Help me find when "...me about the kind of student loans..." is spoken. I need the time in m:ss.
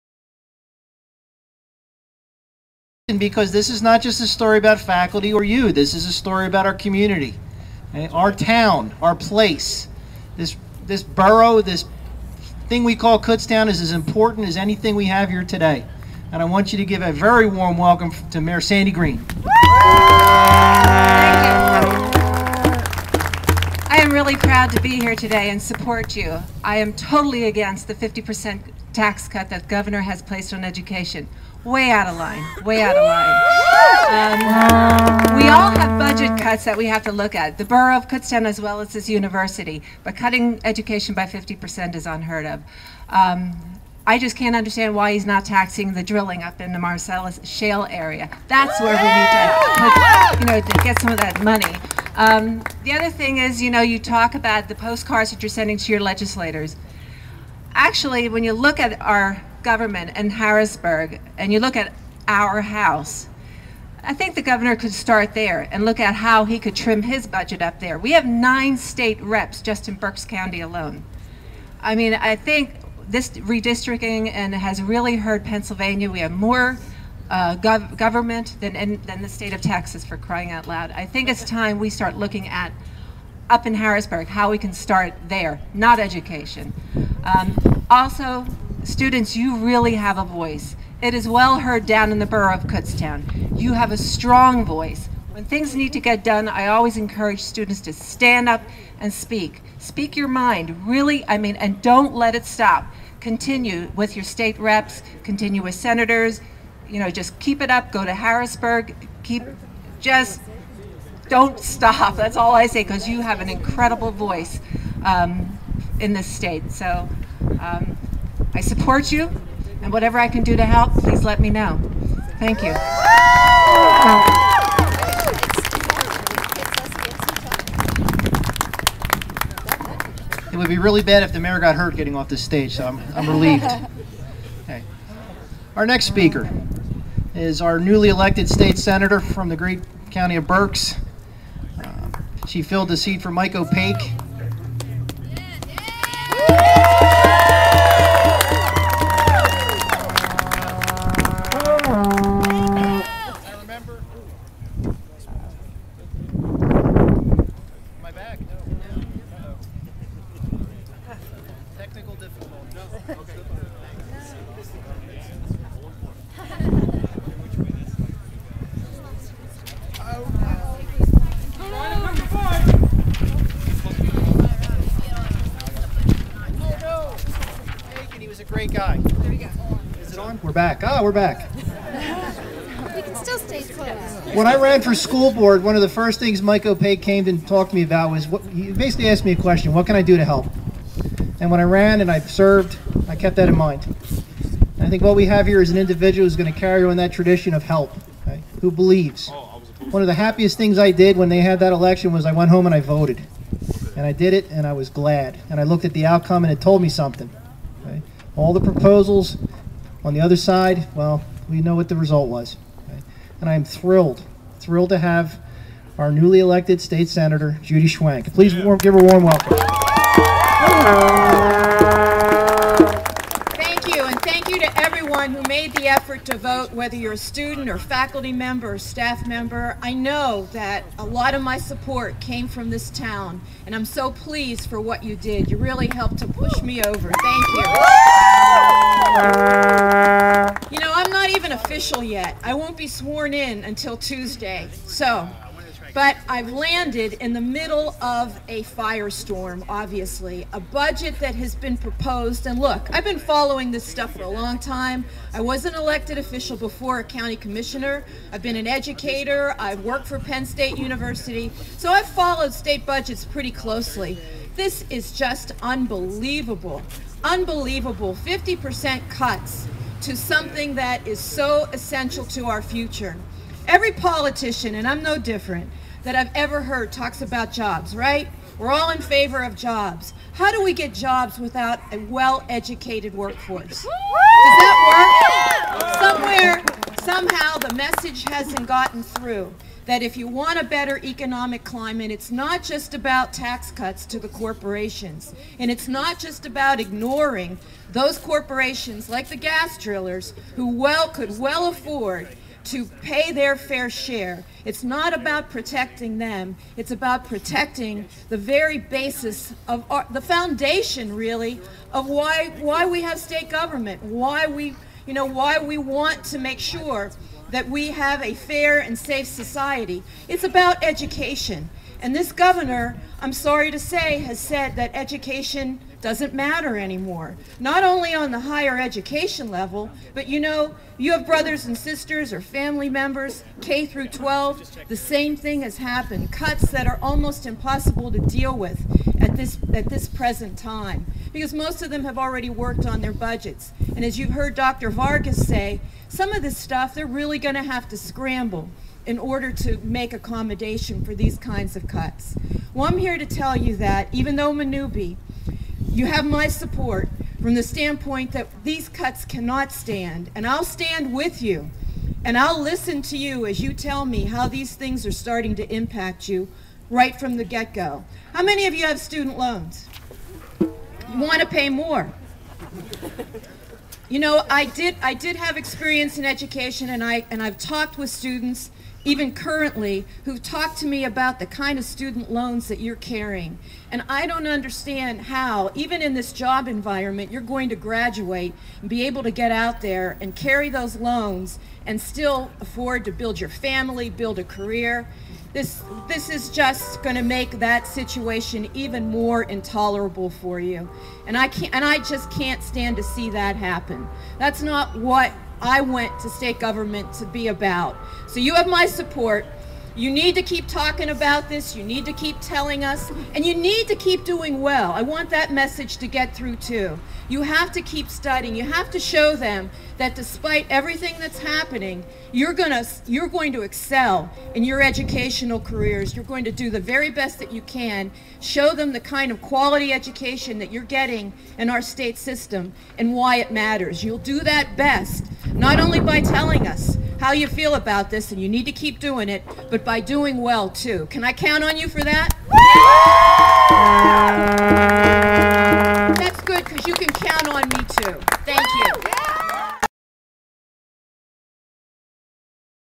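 6:20.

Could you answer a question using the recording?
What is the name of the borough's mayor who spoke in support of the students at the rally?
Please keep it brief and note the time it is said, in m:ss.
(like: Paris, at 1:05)
Sandy Green, at 0:18.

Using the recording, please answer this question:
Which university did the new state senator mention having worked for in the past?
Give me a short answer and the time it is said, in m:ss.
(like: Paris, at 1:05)
Penn State University, at 4:20.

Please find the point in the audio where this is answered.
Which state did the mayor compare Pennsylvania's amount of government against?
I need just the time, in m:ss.
1:19.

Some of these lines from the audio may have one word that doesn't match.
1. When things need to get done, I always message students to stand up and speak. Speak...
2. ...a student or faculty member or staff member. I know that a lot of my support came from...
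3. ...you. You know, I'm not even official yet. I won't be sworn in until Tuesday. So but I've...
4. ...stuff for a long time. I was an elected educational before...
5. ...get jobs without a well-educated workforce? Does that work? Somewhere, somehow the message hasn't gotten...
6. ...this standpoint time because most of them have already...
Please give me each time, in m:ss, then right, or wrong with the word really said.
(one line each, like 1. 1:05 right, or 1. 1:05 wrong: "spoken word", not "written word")
1. 1:35 wrong: "encourage", not "message"
2. 3:47 right
3. 3:57 right
4. 4:13 wrong: "official", not "educational"
5. 4:40 right
6. 5:39 wrong: "present", not "standpoint".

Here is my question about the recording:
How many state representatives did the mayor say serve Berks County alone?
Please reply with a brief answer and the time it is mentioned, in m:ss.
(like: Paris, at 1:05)
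9, at 1:08.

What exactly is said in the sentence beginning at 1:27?
Um, also, students, you really have a voice.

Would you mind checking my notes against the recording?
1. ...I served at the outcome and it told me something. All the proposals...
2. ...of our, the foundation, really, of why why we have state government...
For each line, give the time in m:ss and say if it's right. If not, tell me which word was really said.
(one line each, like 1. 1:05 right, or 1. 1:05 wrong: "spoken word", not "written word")
1. 3:25 wrong: "looked", not "served"
2. 5:09 right.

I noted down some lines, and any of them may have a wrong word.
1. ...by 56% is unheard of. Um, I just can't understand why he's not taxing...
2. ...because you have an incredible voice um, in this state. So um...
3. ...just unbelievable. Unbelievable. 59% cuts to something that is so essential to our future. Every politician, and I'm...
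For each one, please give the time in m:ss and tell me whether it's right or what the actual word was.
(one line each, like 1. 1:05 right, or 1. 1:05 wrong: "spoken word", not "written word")
1. 0:41 wrong: "50", not "56"
2. 1:52 right
3. 4:25 wrong: "50", not "59".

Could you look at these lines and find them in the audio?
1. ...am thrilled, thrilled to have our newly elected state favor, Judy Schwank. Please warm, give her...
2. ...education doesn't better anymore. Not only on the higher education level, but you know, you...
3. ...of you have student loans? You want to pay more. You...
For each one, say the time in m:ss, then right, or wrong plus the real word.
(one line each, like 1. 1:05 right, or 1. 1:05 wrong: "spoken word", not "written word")
1. 3:33 wrong: "senator", not "favor"
2. 5:24 wrong: "matter", not "better"
3. 6:08 right.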